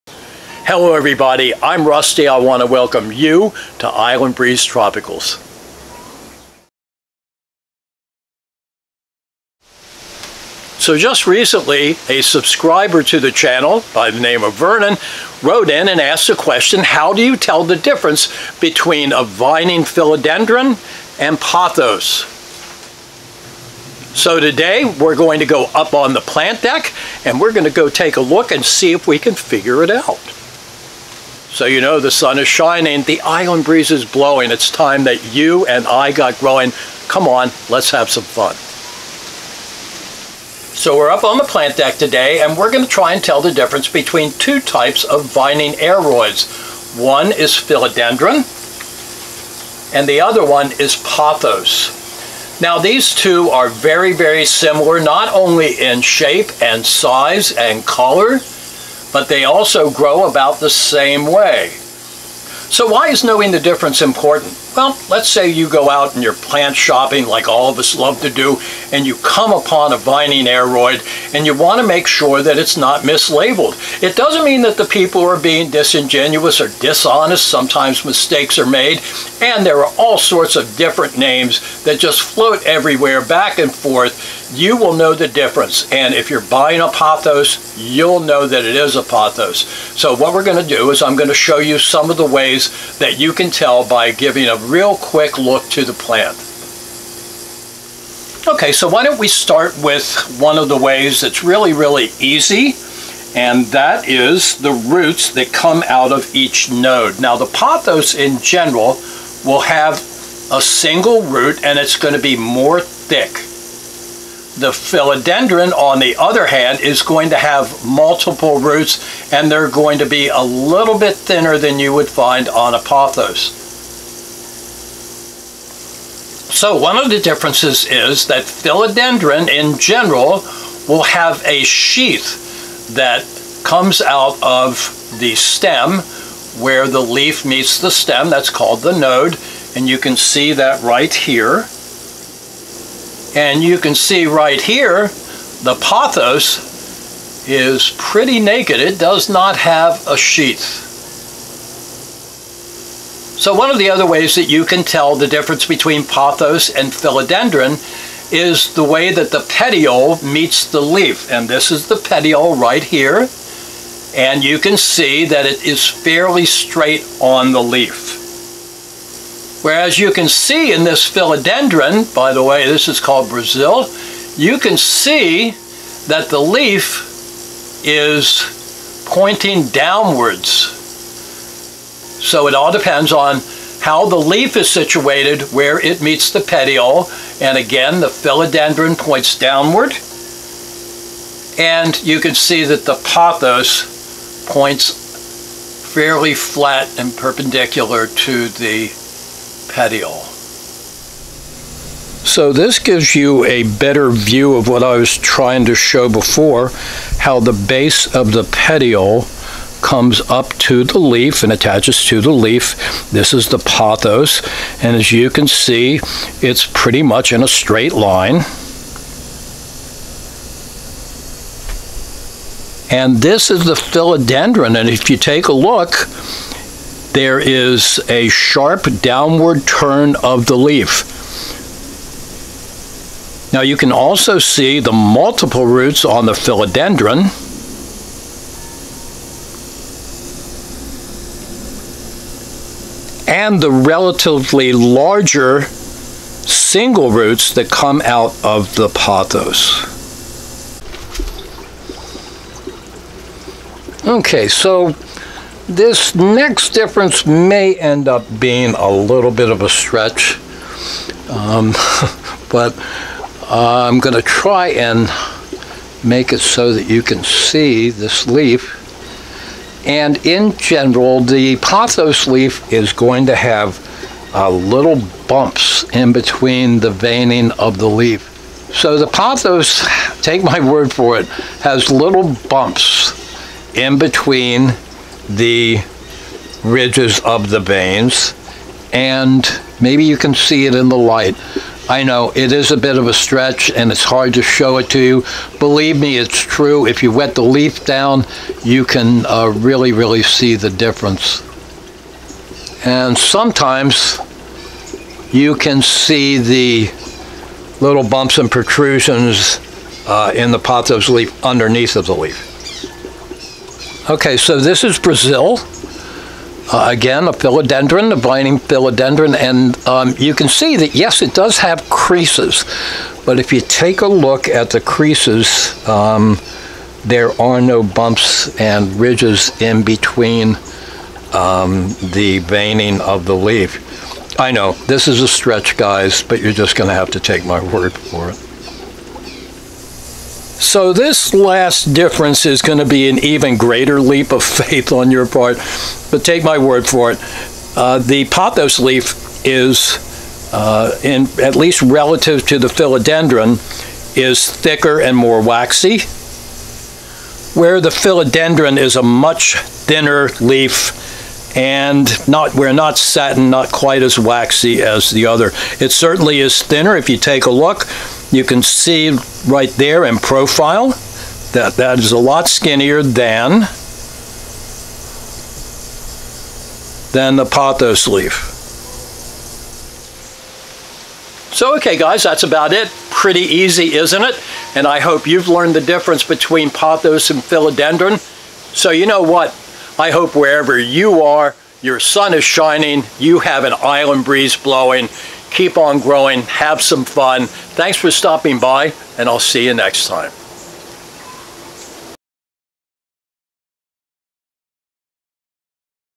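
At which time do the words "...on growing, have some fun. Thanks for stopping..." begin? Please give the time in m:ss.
6:35.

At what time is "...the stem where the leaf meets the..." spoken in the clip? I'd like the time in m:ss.
2:15.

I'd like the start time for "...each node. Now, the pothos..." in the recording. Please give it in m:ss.
1:46.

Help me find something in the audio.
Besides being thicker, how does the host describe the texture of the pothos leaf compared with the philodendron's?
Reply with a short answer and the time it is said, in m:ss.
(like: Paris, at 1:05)
more waxy, at 5:55.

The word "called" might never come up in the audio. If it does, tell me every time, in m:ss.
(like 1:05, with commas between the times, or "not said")
2:18, 2:52.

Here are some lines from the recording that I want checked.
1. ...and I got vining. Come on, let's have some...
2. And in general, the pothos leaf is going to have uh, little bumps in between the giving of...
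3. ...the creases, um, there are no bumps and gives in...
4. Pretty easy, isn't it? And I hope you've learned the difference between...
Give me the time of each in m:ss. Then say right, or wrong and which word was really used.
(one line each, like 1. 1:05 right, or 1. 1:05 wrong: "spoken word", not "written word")
1. 0:35 wrong: "growing", not "vining"
2. 4:29 wrong: "veining", not "giving"
3. 5:24 wrong: "ridges", not "gives"
4. 6:23 right.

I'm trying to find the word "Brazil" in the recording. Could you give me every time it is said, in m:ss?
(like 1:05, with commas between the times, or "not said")
2:53, 5:14.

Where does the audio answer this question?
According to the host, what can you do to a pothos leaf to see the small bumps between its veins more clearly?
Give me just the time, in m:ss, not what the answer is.
4:57.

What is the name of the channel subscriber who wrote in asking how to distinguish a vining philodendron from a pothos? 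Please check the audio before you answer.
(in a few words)
Vernon.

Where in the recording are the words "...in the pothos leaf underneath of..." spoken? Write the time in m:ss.
5:10.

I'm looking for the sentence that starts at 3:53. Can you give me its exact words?
Now you can also see the multiple roots on the philodendron.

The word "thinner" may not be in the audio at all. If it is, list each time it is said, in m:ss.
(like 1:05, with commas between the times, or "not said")
2:01, 5:59, 6:06.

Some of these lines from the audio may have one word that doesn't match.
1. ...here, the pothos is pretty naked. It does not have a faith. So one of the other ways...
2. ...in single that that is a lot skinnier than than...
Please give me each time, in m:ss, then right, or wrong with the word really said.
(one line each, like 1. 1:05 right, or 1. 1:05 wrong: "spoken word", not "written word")
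1. 2:24 wrong: "sheath", not "faith"
2. 6:10 wrong: "profile", not "single".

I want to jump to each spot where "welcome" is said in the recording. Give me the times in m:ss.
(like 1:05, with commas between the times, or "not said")
0:02.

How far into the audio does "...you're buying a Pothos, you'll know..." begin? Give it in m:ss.
1:26.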